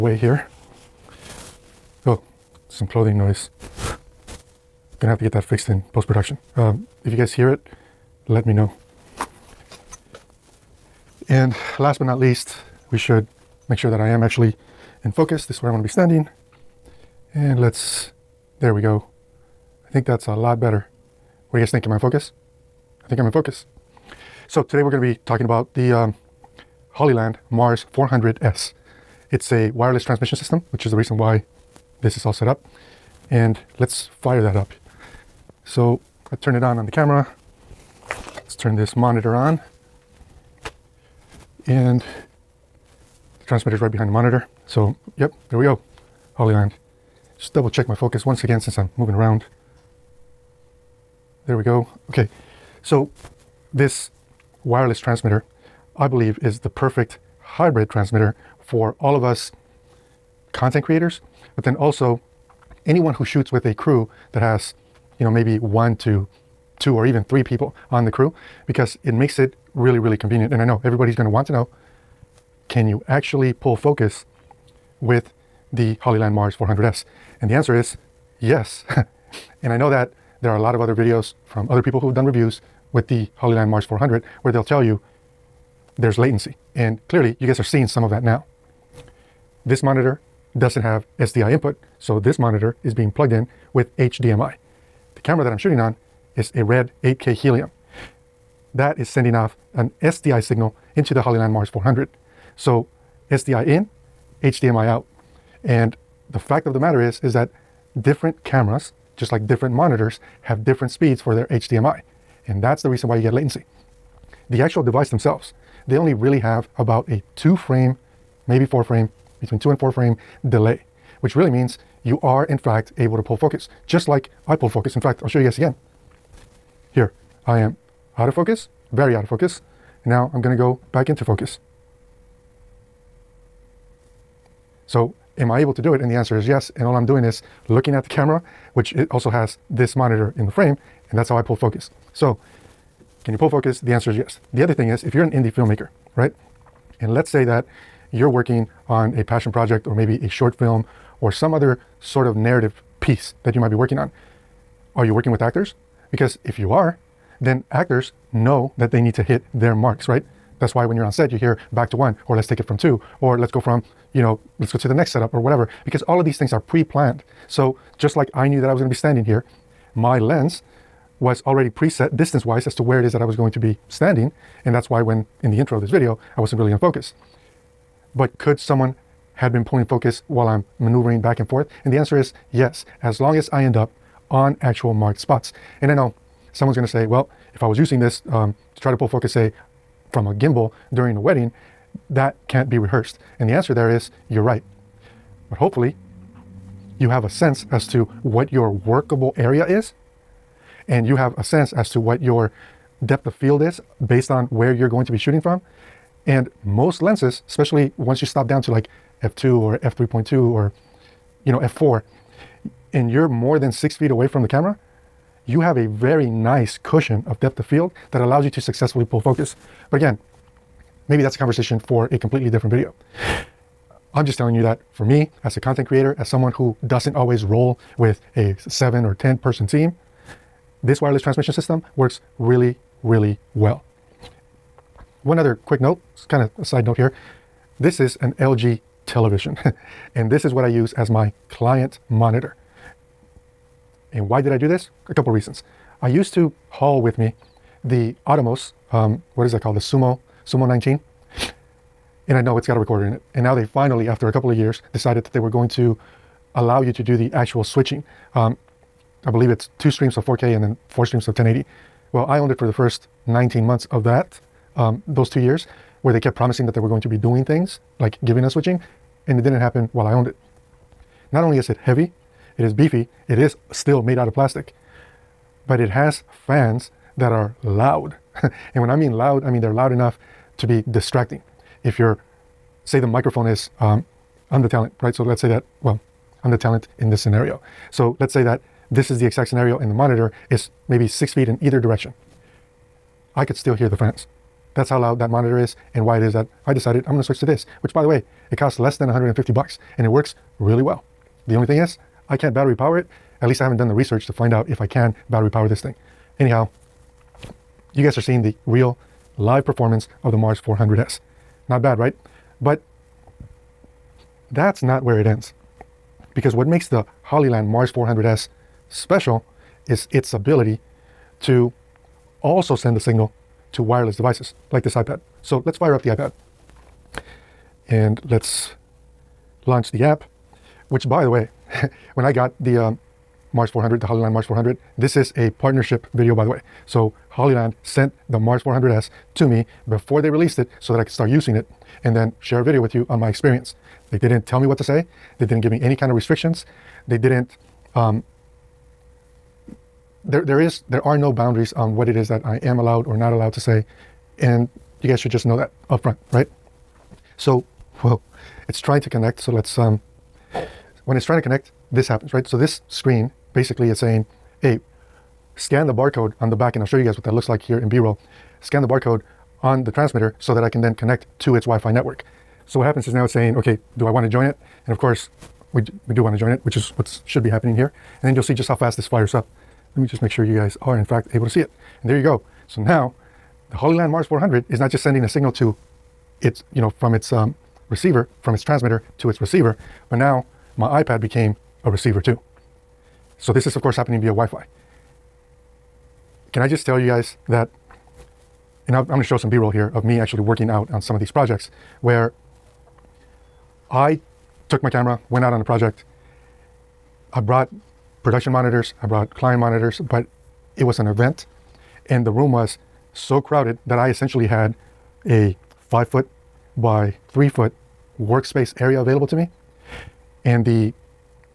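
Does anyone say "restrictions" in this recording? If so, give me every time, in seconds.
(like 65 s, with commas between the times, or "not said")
346 s.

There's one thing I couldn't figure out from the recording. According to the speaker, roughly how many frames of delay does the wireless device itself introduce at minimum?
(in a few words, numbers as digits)
2 frames.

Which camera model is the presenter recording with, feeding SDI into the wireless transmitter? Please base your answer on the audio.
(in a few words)
RED 8K Helium.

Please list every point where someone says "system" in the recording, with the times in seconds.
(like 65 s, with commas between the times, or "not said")
30 s, 231 s.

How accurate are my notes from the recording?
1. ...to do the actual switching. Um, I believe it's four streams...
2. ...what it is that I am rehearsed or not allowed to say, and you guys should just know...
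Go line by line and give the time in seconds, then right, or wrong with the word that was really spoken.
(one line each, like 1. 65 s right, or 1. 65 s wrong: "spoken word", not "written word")
1. 256 s wrong: "two", not "four"
2. 351 s wrong: "allowed", not "rehearsed".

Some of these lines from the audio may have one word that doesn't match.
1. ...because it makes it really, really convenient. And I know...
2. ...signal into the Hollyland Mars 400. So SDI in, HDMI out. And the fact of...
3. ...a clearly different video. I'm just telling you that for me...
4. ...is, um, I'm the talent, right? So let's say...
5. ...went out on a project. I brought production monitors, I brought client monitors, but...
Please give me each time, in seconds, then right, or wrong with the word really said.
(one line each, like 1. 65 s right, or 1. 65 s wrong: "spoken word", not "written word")
1. 68 s right
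2. 100 s right
3. 222 s wrong: "completely", not "clearly"
4. 283 s right
5. 405 s right.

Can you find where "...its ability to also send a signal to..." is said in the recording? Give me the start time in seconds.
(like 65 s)
320 s.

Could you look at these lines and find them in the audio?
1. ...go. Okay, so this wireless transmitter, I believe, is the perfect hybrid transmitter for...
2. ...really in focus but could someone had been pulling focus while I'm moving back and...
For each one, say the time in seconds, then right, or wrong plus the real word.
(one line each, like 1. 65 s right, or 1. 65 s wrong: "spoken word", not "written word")
1. 51 s right
2. 176 s wrong: "maneuvering", not "moving".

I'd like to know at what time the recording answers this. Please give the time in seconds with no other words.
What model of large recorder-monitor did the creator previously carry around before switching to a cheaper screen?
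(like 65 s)
249 s.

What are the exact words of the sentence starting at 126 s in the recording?
Here, I am out of focus, very out of focus.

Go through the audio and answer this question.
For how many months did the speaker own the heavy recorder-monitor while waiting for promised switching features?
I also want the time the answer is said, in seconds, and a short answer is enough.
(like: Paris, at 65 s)
19 months, at 263 s.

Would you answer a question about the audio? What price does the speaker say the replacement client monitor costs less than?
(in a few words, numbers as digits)
$150.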